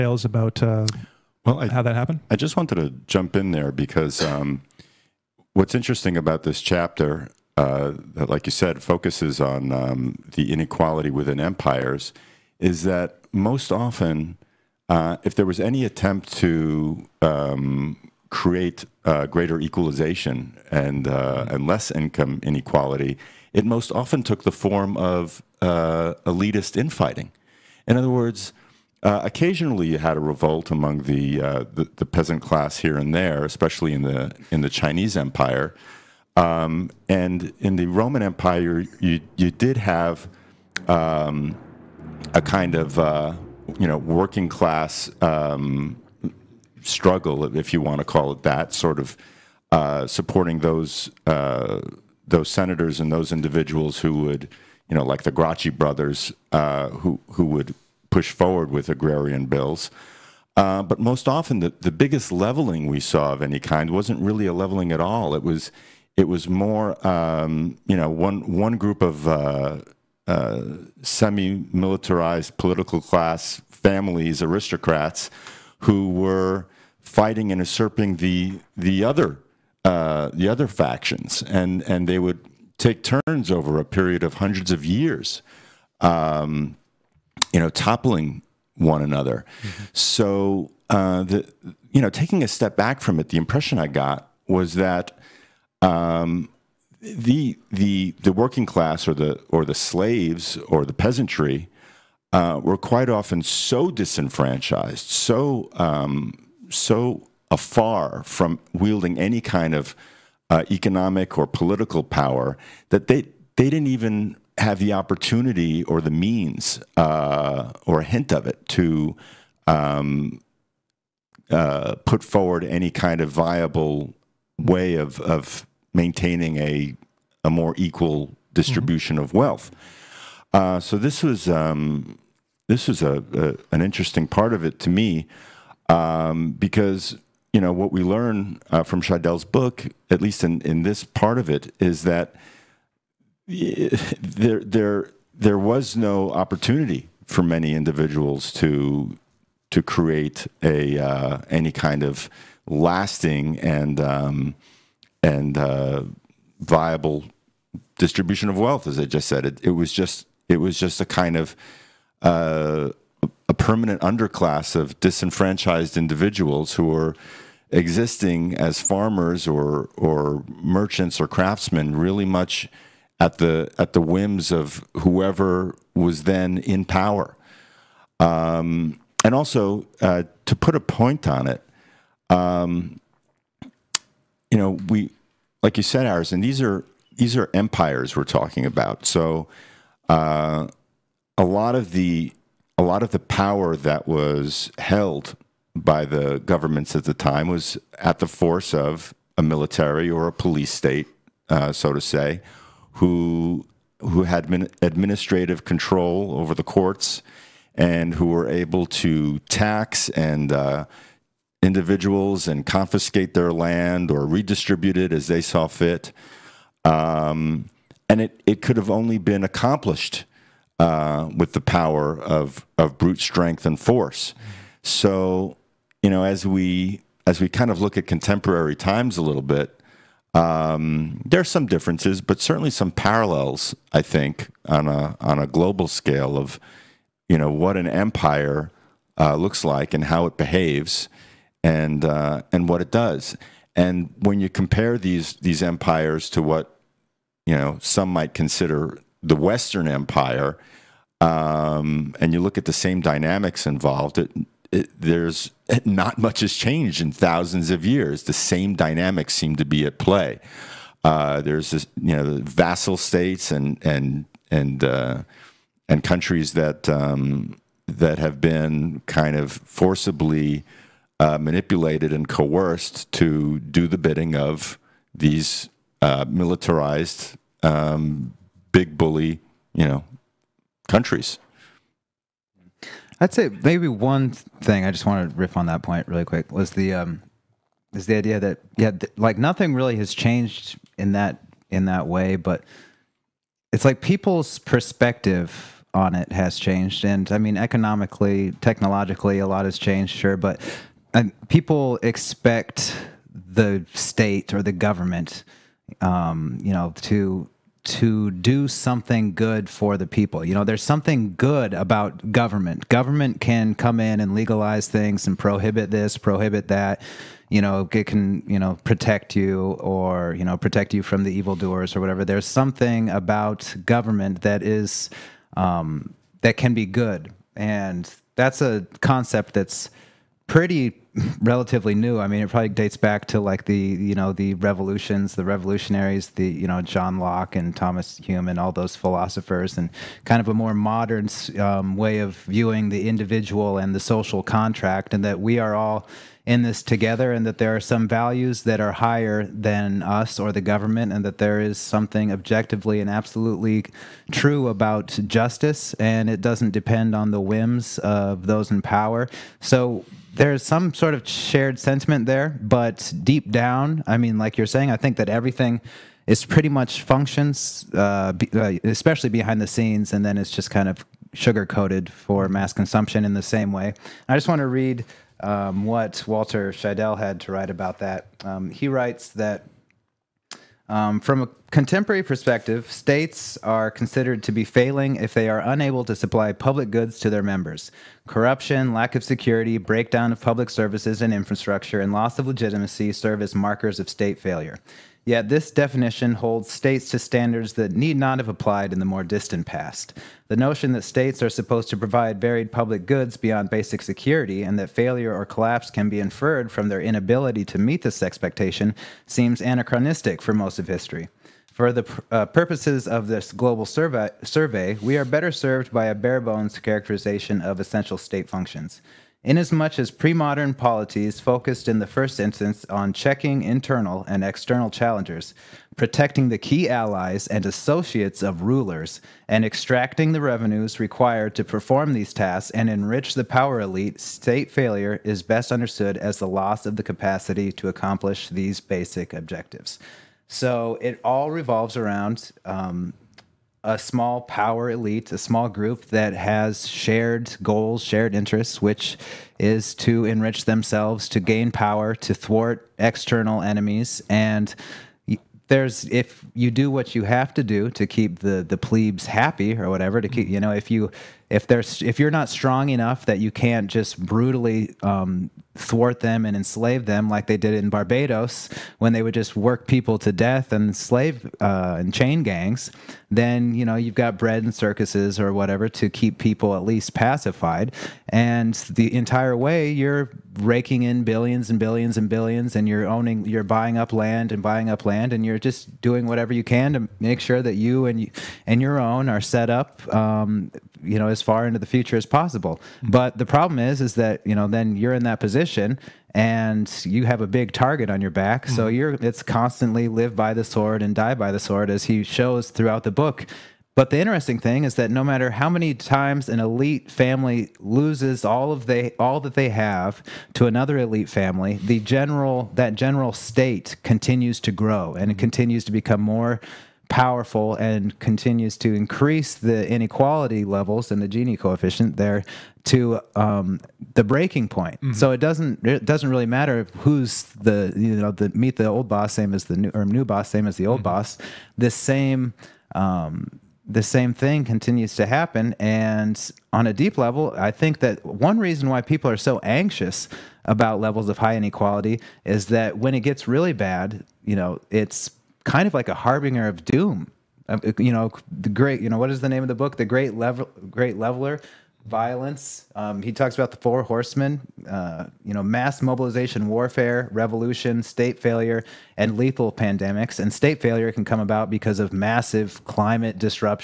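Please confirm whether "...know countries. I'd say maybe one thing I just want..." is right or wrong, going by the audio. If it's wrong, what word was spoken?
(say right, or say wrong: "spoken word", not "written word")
right.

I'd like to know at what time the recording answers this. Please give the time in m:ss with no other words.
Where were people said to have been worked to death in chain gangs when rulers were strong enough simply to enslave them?
7:47.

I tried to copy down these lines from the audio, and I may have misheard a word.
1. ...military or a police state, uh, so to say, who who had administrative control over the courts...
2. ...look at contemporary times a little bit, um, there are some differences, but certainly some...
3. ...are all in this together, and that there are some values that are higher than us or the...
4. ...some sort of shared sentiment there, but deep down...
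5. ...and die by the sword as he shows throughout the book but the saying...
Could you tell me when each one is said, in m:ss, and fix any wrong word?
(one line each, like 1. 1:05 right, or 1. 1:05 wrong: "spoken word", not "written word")
1. 3:19 right
2. 3:47 right
3. 5:45 right
4. 6:00 right
5. 8:21 wrong: "interesting", not "saying".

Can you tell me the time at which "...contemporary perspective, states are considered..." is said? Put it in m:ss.
6:21.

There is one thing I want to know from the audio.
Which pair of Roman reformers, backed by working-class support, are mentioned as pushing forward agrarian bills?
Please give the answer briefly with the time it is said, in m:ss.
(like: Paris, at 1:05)
The Gracchi brothers, at 0:55.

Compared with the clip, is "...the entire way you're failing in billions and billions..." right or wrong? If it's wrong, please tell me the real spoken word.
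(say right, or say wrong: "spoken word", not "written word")
wrong: "raking", not "failing".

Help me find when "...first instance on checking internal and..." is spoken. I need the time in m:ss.
7:02.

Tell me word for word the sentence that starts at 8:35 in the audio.
continues to become more powerful and continues to increase the inequality levels and the Gini coefficient there to um, the breaking point.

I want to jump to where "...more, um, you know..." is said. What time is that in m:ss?
1:06.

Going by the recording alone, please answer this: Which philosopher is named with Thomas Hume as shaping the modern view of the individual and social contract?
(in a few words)
John Locke.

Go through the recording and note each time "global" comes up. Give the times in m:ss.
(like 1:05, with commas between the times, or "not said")
3:55, 6:53.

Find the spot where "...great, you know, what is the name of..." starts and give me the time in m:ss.
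9:08.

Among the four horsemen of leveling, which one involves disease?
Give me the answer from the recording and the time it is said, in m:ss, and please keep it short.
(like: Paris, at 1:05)
Lethal pandemics, at 9:19.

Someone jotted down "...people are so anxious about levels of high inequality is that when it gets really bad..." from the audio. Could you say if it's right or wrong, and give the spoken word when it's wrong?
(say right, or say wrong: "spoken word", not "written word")
right.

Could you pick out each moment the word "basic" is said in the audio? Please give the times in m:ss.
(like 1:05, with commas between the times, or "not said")
6:43, 7:18.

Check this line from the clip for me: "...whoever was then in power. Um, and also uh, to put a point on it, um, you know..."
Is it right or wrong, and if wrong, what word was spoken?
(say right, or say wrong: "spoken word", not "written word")
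right.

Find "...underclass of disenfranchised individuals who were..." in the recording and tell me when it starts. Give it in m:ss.
2:44.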